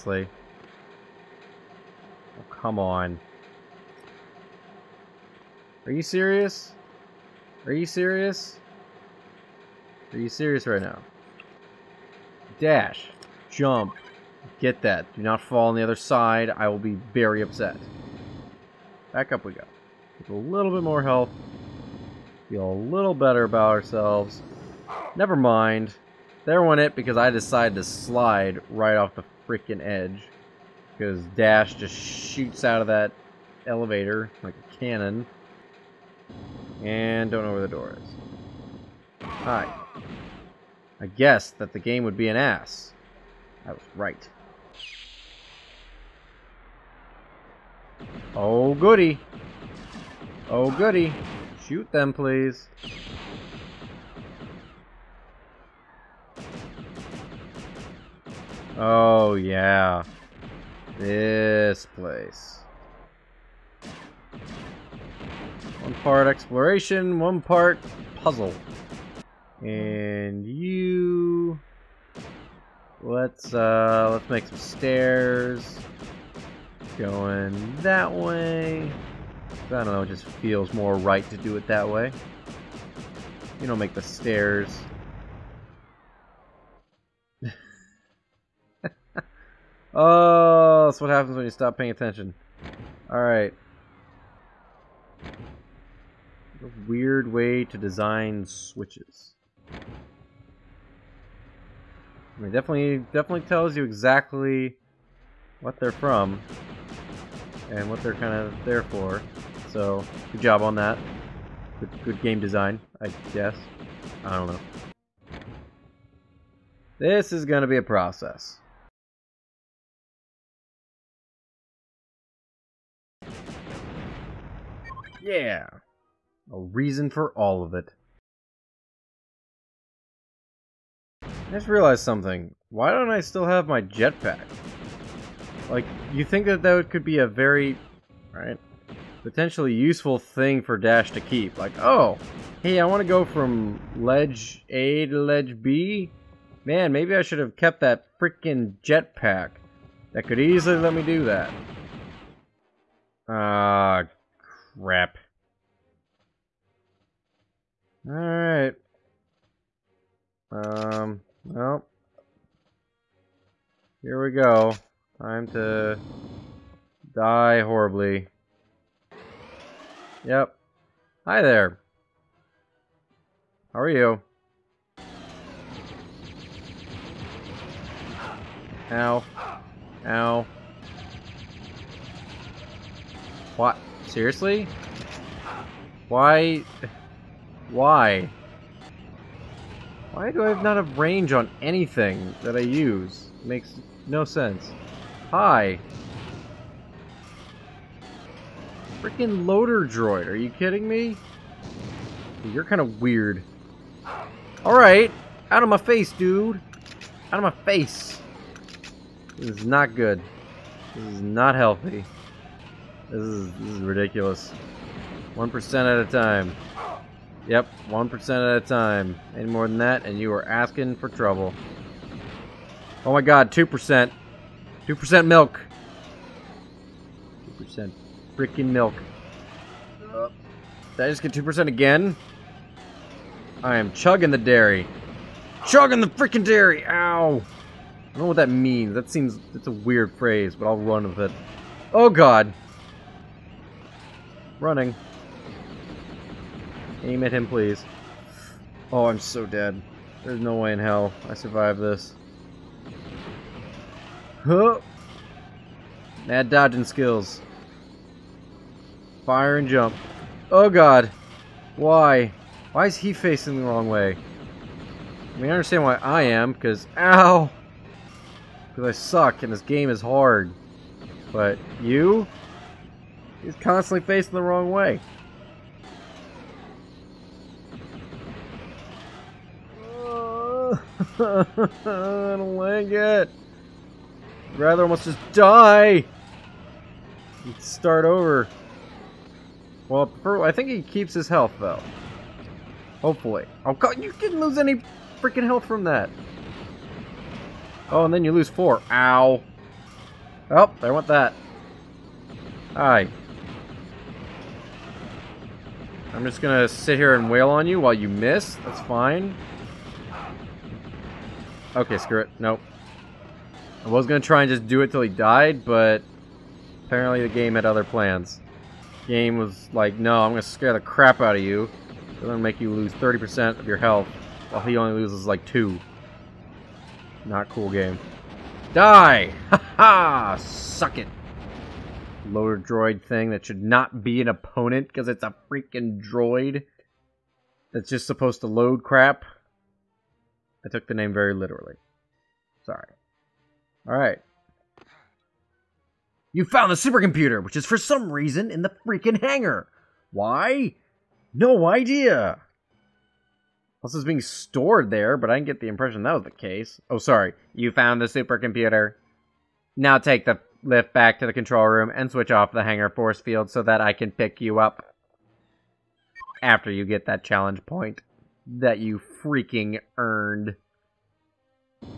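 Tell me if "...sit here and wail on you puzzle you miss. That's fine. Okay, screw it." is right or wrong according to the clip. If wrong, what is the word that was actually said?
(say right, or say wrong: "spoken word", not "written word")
wrong: "while", not "puzzle".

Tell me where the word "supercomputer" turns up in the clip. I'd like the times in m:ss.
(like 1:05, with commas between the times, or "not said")
5:46, 5:58.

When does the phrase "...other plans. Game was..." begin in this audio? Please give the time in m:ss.
5:17.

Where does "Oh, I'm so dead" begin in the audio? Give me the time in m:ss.
4:08.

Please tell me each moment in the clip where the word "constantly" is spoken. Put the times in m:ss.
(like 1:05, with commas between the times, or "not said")
4:33.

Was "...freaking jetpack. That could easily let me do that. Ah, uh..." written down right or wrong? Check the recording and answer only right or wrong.
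right.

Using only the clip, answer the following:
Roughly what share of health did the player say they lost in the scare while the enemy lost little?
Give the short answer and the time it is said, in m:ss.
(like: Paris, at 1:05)
30%, at 5:22.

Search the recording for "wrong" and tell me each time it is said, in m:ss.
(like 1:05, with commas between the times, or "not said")
4:23, 4:34.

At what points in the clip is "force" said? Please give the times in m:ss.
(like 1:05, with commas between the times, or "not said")
6:02.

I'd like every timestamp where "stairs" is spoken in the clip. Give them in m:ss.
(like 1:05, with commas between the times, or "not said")
1:14, 1:24.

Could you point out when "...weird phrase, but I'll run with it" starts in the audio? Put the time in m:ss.
3:59.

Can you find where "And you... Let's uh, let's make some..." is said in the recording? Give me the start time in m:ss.
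1:09.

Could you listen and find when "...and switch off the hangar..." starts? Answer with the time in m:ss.
6:01.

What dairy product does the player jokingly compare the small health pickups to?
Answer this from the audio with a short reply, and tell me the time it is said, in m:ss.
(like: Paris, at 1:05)
2% milk, at 3:44.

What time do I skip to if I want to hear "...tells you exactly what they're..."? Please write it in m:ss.
1:43.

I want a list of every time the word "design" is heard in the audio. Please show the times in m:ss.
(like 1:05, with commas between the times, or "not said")
1:37, 1:52.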